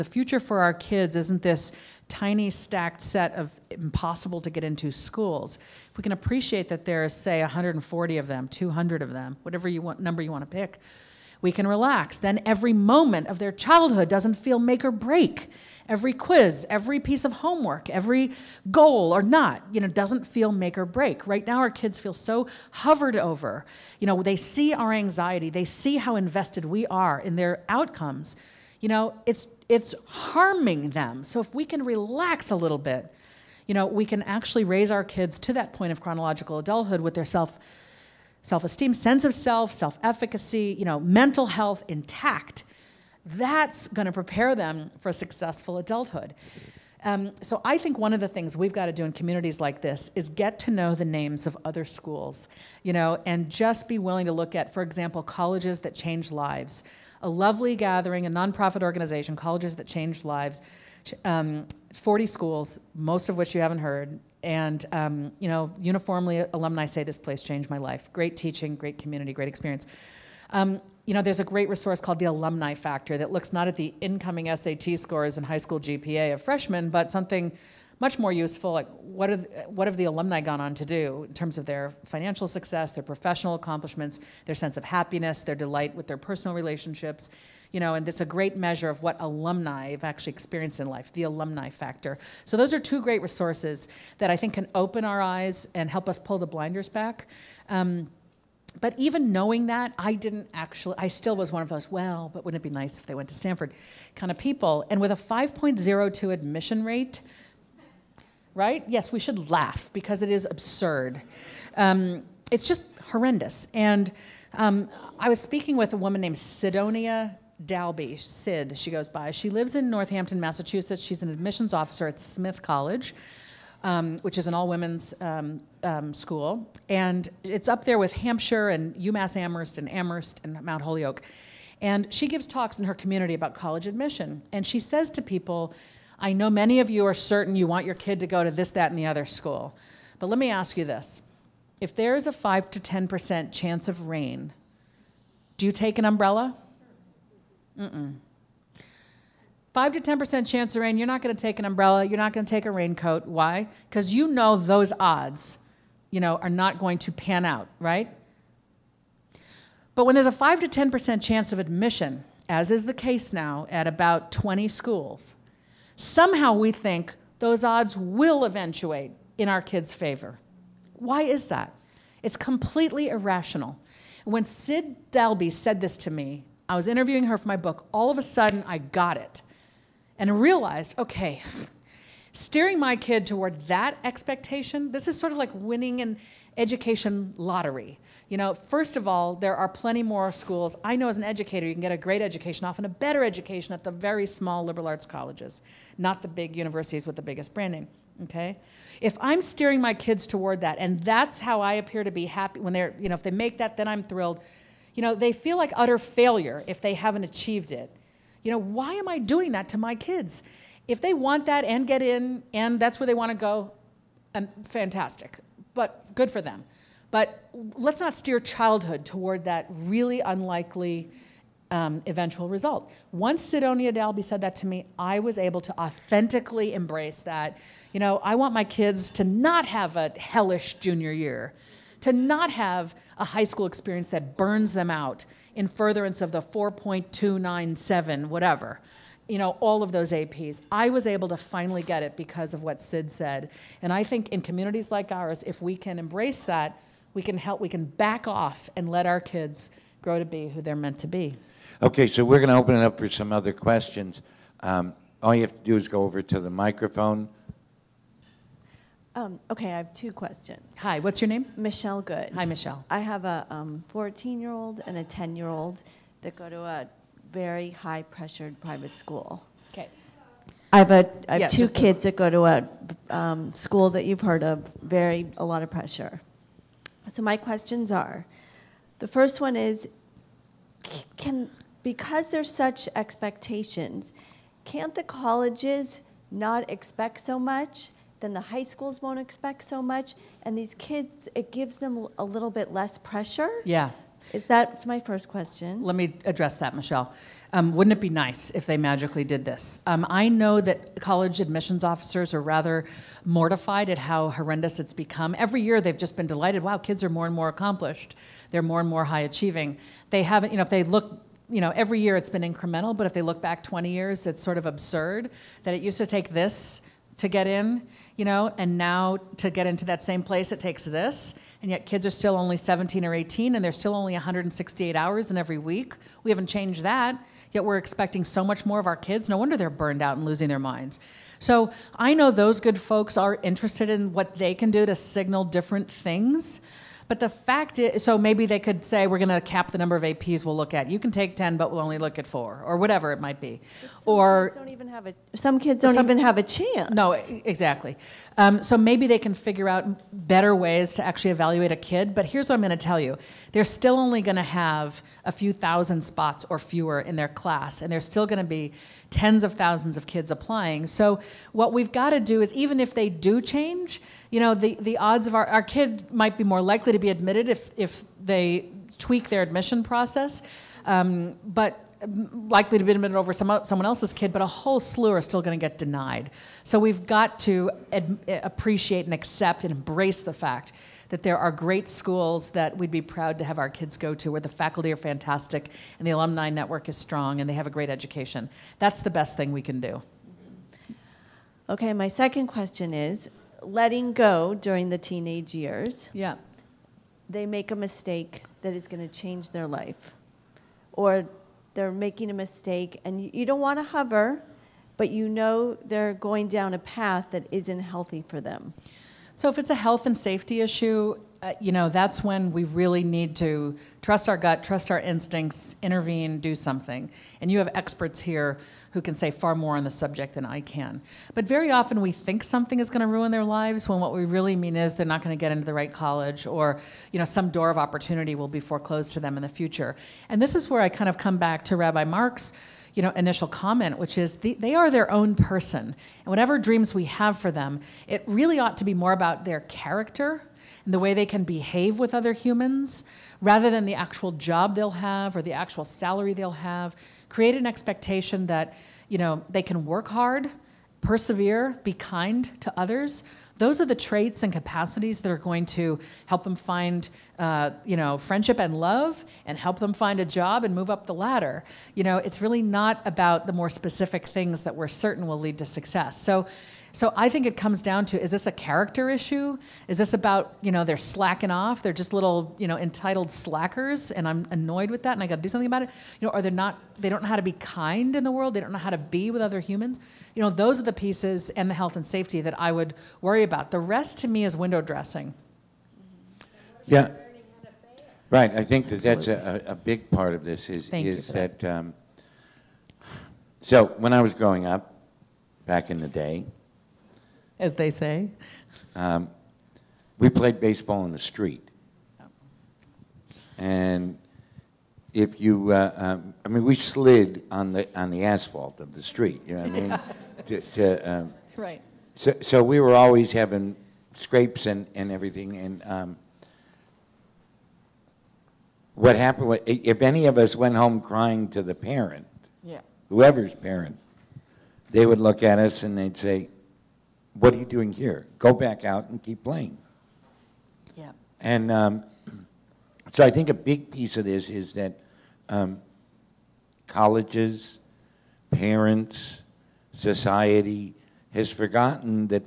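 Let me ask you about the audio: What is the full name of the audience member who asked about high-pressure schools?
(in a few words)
Michelle Good.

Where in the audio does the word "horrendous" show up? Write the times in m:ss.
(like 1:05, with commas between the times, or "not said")
1:53, 5:04.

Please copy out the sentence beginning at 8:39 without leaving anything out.
Was, if any of us went home crying to the parent, yeah.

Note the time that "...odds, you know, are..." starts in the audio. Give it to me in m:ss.
2:35.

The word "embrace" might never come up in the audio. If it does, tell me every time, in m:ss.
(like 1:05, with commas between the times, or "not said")
3:46, 4:05, 6:19.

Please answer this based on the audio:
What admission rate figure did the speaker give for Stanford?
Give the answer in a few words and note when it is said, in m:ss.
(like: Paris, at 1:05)
5.02, at 1:45.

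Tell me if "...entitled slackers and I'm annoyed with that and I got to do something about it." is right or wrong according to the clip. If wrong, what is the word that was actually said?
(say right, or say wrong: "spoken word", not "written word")
right.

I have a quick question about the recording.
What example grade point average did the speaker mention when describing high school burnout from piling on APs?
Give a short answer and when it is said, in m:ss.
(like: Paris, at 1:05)
4.297, at 3:56.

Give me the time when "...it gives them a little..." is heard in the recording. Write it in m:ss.
4:51.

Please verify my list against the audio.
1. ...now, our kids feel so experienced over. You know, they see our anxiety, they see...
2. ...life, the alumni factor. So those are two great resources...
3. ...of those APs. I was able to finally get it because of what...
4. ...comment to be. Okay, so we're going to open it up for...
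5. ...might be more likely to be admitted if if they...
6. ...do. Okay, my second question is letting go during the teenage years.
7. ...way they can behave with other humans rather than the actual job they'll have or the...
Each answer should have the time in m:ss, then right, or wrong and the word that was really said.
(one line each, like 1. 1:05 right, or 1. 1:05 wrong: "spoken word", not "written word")
1. 0:21 wrong: "hovered", not "experienced"
2. 1:30 right
3. 3:59 right
4. 4:10 wrong: "meant", not "comment"
5. 6:06 right
6. 6:29 right
7. 7:20 right.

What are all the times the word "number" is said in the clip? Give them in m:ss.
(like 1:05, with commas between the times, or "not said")
0:09, 5:39.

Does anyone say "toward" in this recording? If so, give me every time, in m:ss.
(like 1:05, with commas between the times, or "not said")
3:03, 3:20, 3:39.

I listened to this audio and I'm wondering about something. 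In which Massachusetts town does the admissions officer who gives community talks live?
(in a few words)
Northampton.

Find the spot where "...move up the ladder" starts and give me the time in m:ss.
7:40.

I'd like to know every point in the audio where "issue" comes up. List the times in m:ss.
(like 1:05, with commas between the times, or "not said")
6:50, 7:49.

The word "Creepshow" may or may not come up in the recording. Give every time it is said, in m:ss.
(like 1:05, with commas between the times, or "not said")
not said.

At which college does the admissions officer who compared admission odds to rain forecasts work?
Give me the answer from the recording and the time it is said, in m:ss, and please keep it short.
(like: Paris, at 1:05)
Smith College, at 2:02.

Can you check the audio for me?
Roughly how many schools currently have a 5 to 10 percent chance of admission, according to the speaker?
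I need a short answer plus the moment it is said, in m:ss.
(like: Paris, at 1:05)
20, at 2:43.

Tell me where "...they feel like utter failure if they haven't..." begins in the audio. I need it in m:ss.
3:25.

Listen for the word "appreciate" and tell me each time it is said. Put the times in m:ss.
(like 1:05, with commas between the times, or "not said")
0:06, 6:18.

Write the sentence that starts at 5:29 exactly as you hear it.
No wonder they're burned out and losing their minds.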